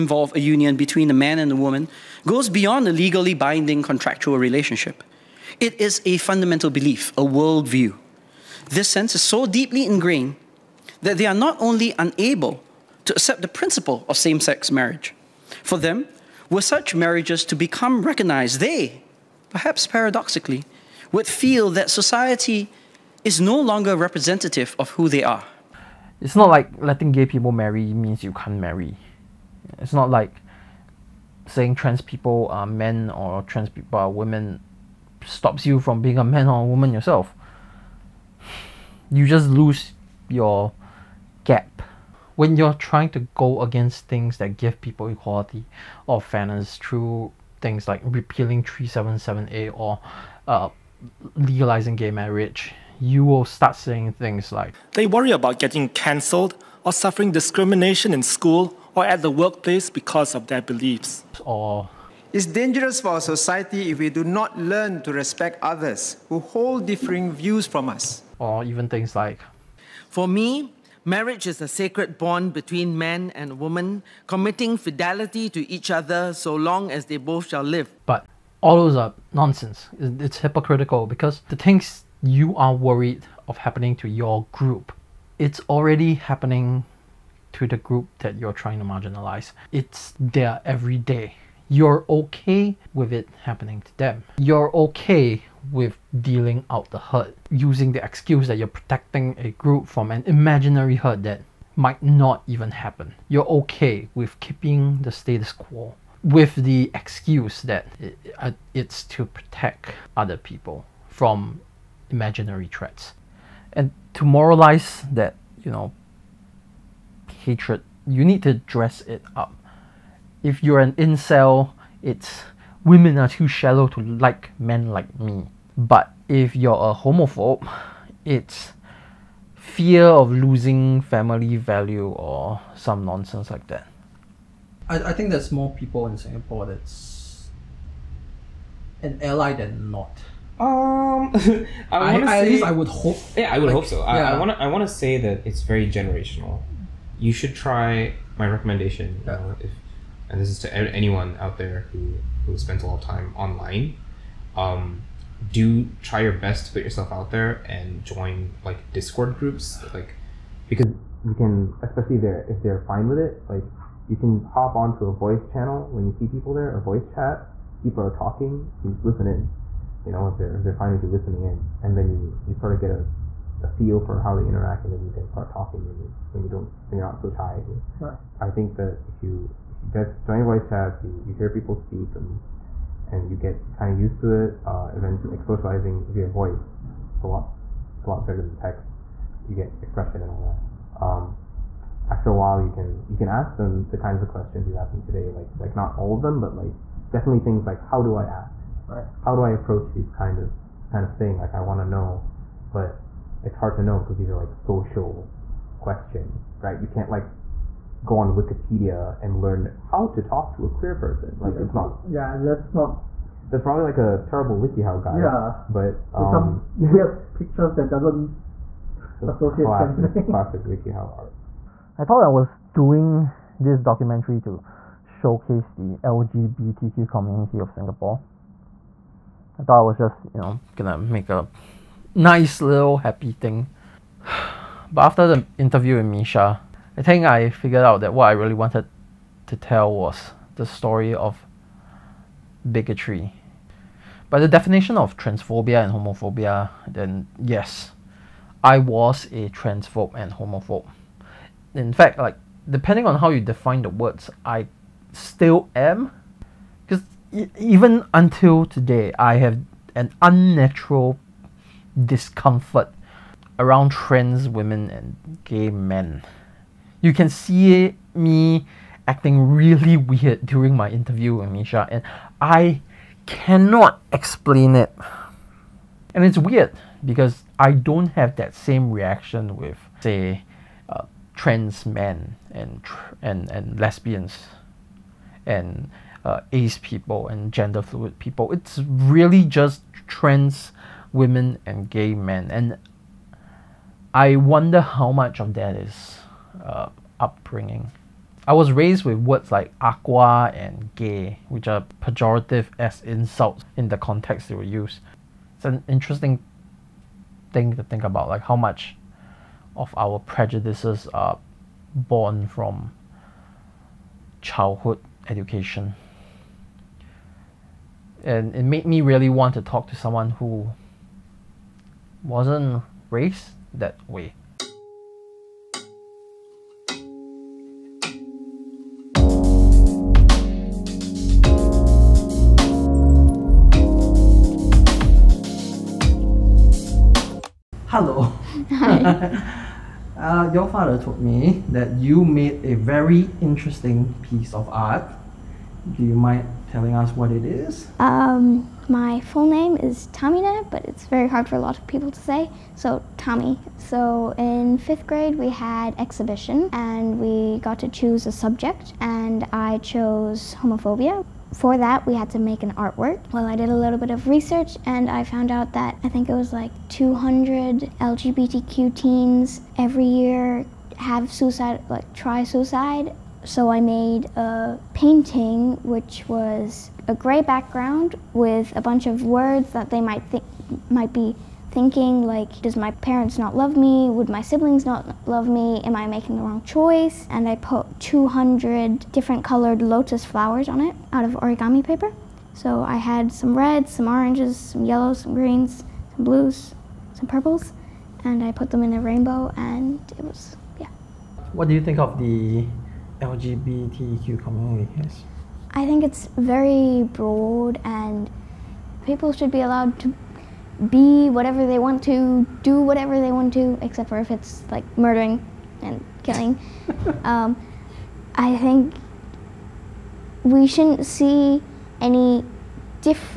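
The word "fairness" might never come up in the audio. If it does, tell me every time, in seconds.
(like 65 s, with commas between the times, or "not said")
46 s.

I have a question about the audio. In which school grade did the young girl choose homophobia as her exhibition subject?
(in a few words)
fifth grade.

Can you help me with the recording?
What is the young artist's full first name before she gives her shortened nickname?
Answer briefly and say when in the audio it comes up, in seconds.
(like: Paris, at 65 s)
Tahmina, at 350 s.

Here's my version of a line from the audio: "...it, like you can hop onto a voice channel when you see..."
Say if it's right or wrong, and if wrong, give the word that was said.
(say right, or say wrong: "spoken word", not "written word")
right.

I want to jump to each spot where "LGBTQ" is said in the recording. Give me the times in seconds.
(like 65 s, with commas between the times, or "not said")
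225 s, 367 s, 403 s.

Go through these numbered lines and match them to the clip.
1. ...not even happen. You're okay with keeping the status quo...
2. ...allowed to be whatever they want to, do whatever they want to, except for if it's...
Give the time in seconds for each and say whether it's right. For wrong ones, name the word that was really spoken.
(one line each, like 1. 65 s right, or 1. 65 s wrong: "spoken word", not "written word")
1. 102 s right
2. 409 s right.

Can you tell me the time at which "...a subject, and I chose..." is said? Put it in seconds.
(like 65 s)
358 s.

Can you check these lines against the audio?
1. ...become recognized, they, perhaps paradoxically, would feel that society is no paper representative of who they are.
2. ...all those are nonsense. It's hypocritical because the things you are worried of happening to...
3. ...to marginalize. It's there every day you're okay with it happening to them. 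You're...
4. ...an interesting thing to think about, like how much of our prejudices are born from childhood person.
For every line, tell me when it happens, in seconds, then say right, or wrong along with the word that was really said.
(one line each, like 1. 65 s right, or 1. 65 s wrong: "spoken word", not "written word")
1. 17 s wrong: "longer", not "paper"
2. 78 s right
3. 88 s right
4. 305 s wrong: "education", not "person".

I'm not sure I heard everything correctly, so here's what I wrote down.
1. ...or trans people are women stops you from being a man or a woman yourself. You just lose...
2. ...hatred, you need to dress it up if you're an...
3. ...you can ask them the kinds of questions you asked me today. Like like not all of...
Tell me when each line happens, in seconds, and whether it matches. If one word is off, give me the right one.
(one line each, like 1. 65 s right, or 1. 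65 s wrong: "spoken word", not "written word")
1. 33 s right
2. 117 s right
3. 193 s right.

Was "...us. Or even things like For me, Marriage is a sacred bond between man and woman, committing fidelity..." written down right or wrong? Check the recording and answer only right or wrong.
right.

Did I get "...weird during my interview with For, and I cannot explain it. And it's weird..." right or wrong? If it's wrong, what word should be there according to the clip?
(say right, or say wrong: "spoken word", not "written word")
wrong: "Mischa", not "For".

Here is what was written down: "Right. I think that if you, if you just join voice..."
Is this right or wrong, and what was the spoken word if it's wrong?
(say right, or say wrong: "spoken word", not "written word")
right.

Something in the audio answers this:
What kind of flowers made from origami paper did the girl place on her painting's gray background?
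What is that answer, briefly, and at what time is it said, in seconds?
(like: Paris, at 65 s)
lotus, at 389 s.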